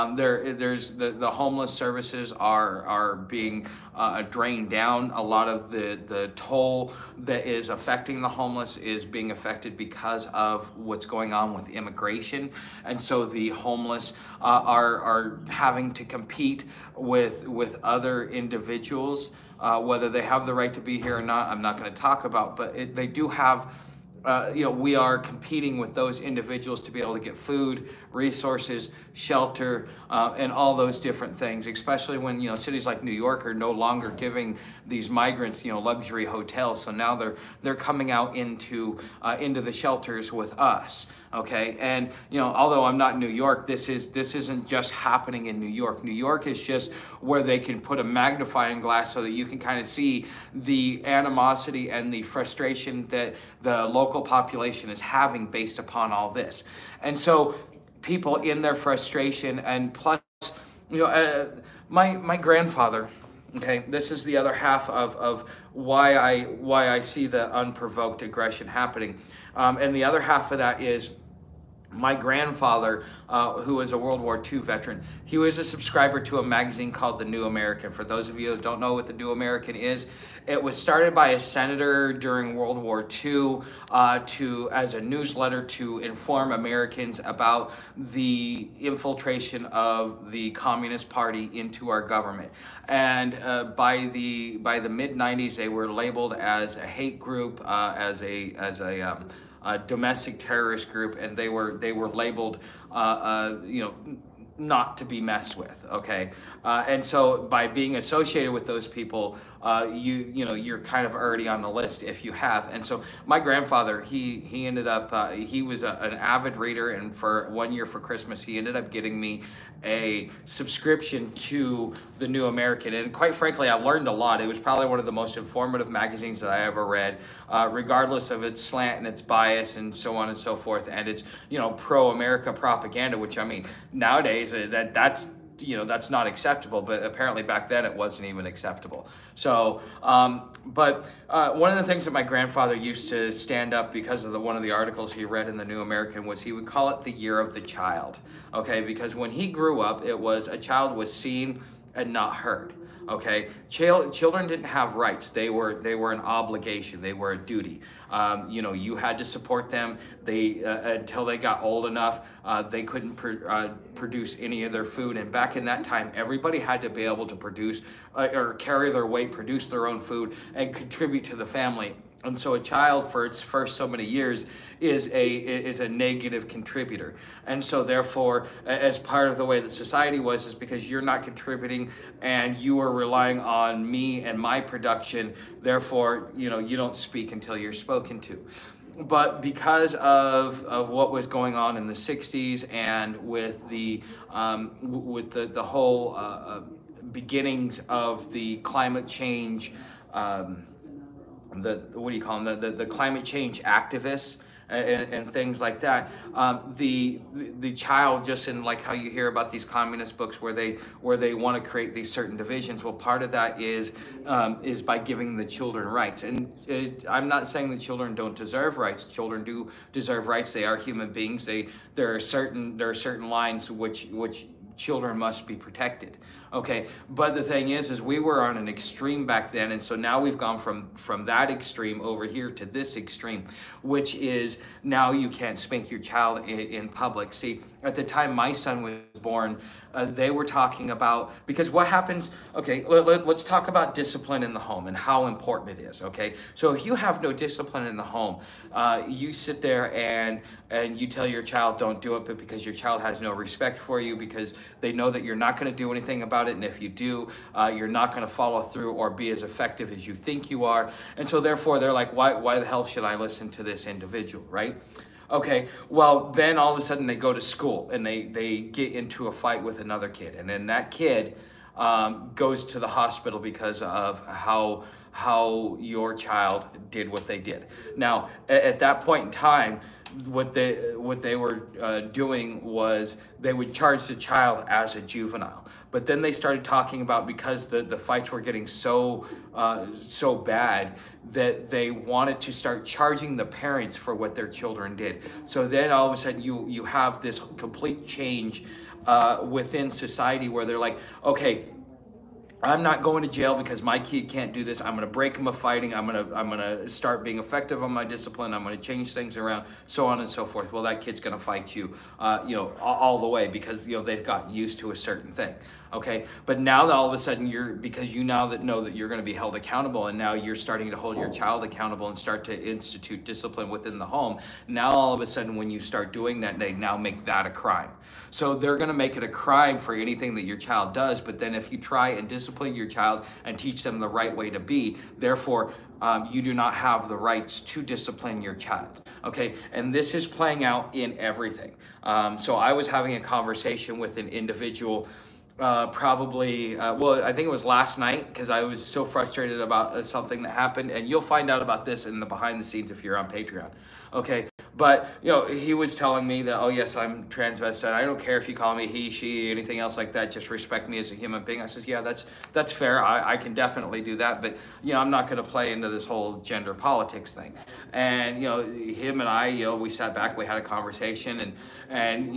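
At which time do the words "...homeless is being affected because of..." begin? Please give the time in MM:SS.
00:08.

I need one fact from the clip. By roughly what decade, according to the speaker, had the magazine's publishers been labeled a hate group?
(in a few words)
the mid '90s.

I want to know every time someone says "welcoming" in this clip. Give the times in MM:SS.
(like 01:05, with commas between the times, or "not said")
not said.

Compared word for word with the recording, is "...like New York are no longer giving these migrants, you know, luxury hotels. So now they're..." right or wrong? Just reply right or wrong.
right.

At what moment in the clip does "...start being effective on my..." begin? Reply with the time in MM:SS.
05:06.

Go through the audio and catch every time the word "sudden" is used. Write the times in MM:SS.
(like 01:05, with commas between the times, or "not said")
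04:26, 04:56, 05:17, 05:25.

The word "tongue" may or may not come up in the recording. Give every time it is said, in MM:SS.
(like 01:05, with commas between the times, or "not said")
not said.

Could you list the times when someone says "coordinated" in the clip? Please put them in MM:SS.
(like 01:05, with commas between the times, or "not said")
not said.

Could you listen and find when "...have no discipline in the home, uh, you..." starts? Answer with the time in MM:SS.
04:06.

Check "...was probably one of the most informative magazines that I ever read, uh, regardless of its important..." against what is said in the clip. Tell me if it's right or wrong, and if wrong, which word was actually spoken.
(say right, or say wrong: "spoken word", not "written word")
wrong: "slant", not "important".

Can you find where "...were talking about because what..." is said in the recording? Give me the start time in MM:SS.
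04:00.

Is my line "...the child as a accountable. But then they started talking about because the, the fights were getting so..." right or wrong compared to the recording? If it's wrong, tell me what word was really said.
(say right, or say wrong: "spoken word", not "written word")
wrong: "juvenile", not "accountable".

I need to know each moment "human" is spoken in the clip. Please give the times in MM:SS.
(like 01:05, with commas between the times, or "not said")
03:40, 06:01.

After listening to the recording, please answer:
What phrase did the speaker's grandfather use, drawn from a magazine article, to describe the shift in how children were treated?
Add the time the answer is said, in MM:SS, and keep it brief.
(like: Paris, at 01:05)
the year of the child, at 02:27.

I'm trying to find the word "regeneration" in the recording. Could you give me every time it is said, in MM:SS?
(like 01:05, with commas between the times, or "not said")
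not said.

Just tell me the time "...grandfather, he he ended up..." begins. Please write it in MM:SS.
01:53.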